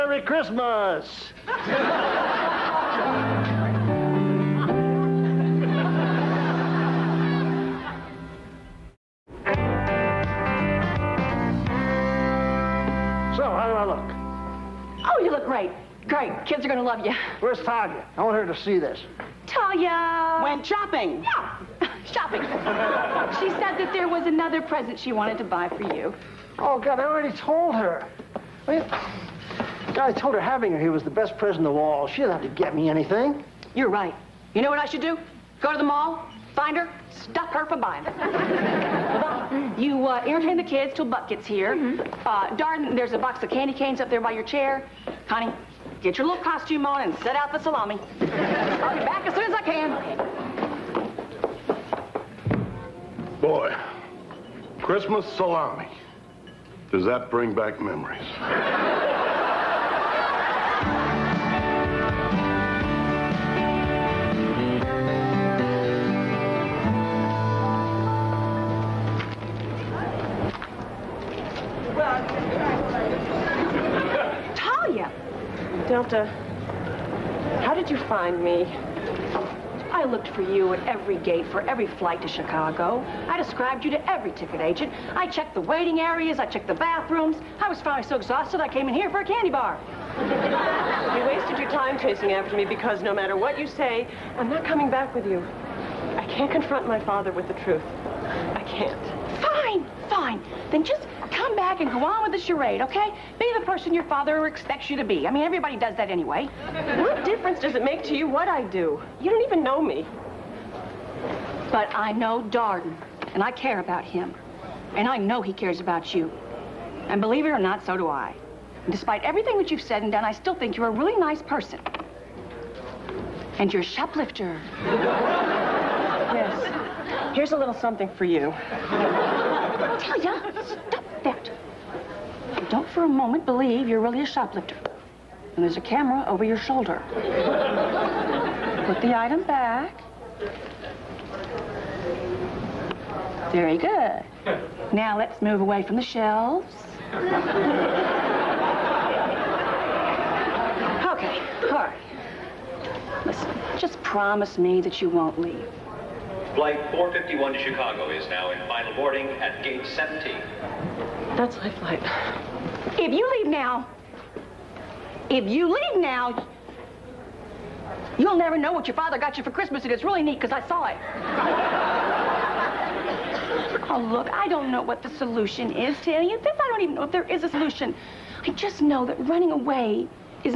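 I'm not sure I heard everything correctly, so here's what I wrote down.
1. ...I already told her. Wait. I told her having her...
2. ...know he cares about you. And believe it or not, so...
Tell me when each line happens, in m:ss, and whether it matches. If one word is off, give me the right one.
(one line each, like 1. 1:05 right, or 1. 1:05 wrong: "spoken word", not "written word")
1. 0:26 right
2. 1:55 right.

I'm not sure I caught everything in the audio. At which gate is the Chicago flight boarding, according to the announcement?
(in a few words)
Gate 17.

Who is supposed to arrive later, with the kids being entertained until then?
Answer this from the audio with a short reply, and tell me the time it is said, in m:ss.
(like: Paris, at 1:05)
Buck, at 0:41.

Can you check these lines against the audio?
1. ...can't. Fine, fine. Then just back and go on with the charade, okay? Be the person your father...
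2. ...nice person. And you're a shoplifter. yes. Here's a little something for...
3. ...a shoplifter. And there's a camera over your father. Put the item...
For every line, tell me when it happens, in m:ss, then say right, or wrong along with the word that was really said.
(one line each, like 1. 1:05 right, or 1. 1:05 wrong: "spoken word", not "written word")
1. 1:38 right
2. 2:01 right
3. 2:14 wrong: "shoulder", not "father".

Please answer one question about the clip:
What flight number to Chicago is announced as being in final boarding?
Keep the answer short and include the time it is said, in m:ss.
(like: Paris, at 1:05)
451, at 2:36.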